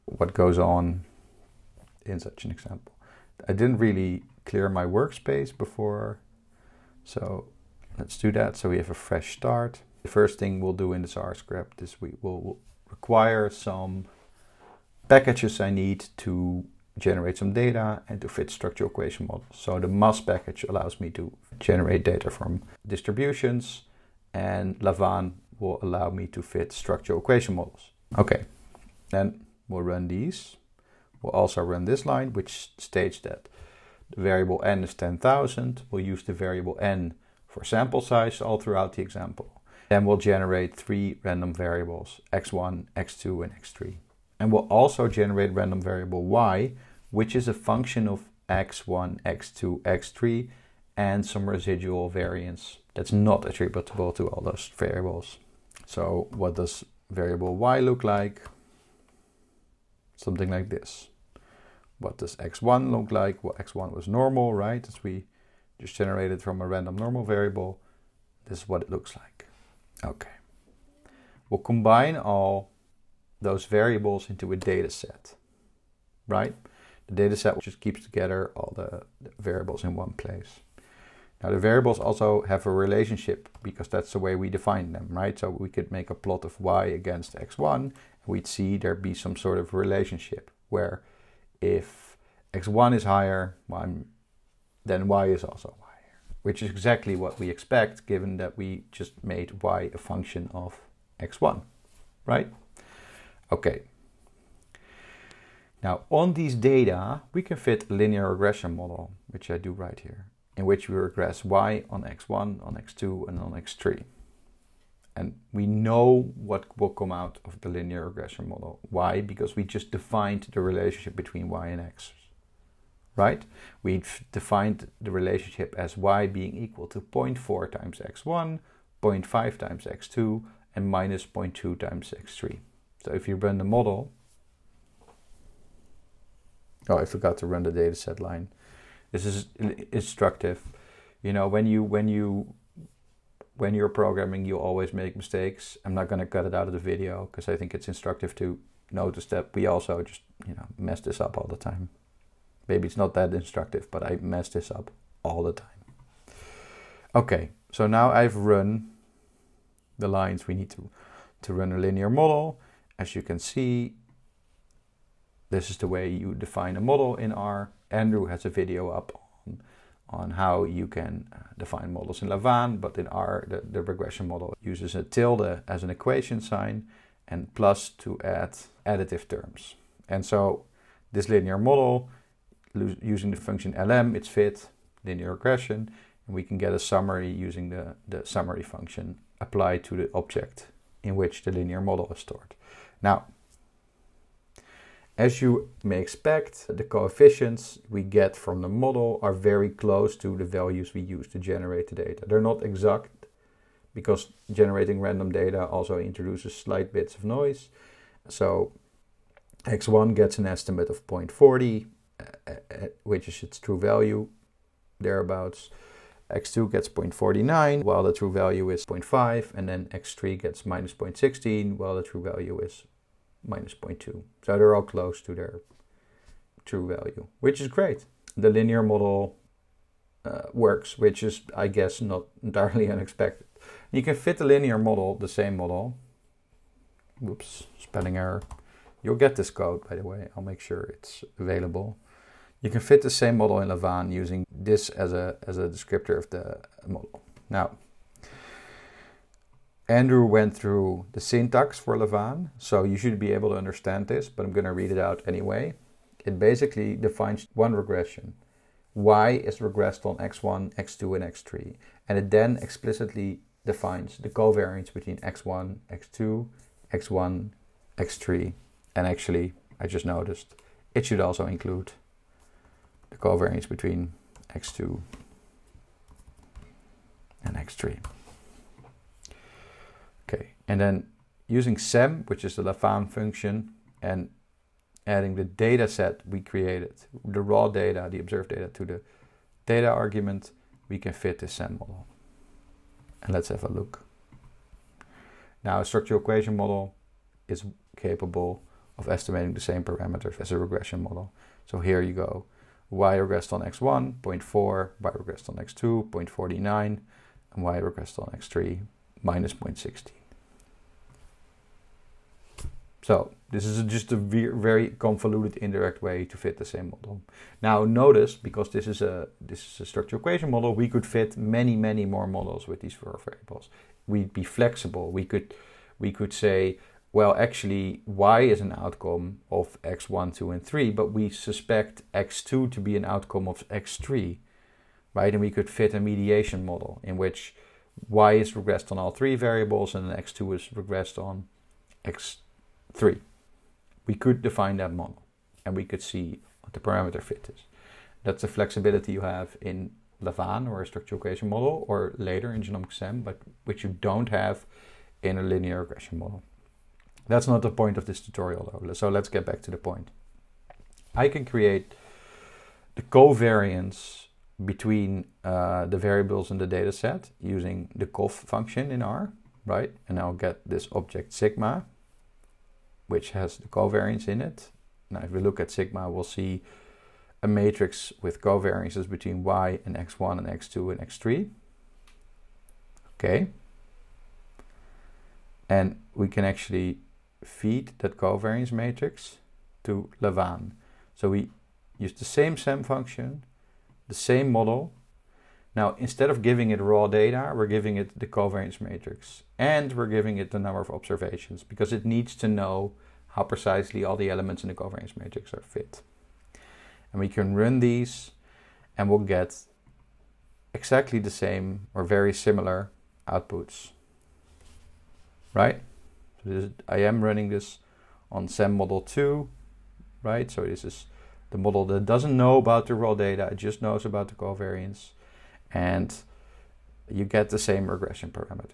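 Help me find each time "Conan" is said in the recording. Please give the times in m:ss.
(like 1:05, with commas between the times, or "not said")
not said.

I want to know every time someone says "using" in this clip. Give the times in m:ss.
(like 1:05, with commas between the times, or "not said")
3:02, 3:07, 4:04, 4:41, 6:07.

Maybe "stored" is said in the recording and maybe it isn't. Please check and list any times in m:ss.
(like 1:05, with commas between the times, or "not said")
3:12.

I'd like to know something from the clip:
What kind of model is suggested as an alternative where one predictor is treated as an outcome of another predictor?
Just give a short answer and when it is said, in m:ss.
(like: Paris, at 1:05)
mediation model, at 5:35.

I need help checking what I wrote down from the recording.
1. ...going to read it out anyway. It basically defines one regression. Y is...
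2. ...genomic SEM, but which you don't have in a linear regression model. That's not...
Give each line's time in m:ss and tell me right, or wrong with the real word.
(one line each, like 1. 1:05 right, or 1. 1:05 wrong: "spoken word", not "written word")
1. 4:14 right
2. 5:52 right.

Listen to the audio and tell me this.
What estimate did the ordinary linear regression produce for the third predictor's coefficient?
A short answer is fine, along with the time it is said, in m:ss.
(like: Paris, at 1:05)
-0.16, at 3:40.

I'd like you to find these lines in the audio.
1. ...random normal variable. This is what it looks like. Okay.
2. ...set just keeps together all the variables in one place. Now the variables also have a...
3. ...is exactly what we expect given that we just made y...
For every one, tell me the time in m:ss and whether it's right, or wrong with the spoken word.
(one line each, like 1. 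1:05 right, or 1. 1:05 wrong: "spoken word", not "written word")
1. 1:06 right
2. 1:17 right
3. 1:36 right.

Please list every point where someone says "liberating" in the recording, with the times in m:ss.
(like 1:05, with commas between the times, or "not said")
not said.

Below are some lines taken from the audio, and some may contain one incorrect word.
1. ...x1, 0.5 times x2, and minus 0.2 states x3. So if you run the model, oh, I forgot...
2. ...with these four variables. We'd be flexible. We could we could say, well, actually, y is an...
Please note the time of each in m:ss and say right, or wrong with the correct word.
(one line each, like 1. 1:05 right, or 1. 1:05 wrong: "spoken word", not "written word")
1. 2:07 wrong: "times", not "states"
2. 5:22 right.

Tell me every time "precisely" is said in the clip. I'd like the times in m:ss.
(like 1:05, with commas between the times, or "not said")
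6:43.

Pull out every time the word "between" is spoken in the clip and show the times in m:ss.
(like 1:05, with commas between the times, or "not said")
2:01, 4:24, 4:33, 6:04, 6:19.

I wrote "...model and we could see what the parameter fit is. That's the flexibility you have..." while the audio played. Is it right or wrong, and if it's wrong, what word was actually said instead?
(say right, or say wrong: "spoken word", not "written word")
right.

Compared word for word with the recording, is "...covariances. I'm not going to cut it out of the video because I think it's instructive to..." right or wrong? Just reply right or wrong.
wrong.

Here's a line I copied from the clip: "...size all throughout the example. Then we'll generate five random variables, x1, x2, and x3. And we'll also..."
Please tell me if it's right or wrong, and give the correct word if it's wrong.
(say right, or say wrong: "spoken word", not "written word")
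wrong: "three", not "five".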